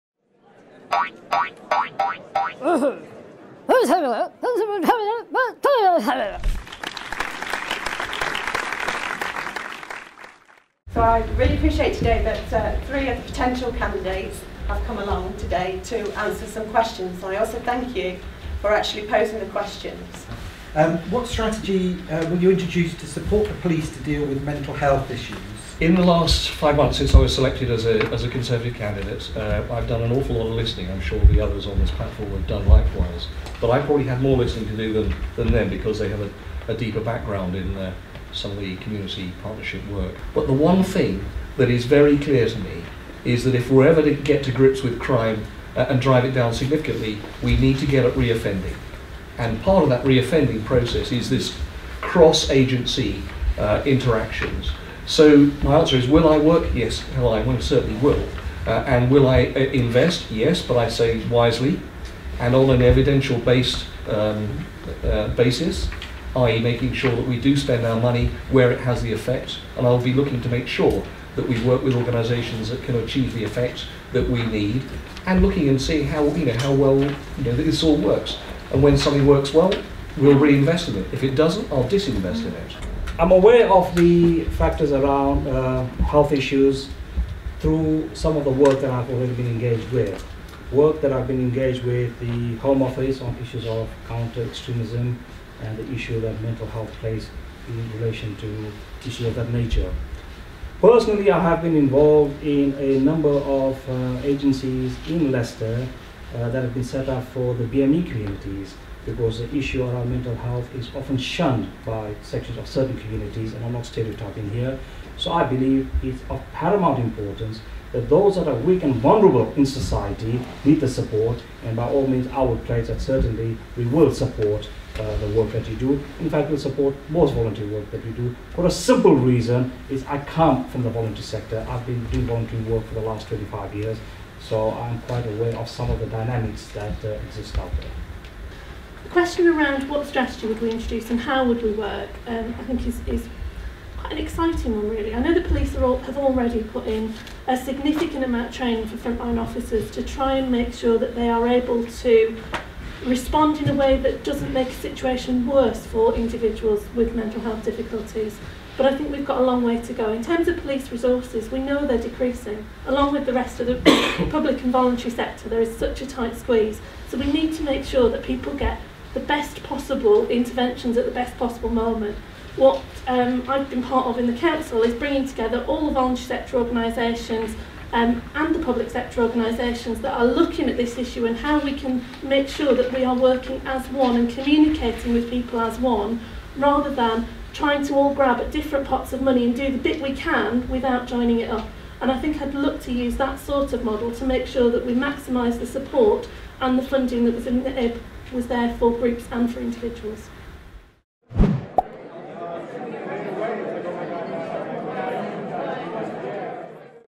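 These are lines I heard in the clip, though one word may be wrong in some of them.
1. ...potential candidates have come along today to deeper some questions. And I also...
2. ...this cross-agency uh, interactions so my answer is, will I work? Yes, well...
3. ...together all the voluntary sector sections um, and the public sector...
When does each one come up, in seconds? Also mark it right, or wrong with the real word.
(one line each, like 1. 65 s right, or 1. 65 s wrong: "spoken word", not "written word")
1. 13 s wrong: "answer", not "deeper"
2. 51 s right
3. 175 s wrong: "organisations", not "sections".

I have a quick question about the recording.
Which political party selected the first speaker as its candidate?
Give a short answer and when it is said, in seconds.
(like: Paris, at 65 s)
Conservative, at 28 s.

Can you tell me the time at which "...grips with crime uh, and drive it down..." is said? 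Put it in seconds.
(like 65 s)
44 s.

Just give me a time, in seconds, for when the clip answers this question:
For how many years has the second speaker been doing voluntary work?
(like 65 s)
133 s.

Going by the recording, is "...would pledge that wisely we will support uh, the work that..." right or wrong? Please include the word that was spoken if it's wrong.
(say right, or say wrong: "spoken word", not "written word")
wrong: "certainly", not "wisely".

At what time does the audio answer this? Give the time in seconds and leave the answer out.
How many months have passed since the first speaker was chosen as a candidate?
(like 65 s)
26 s.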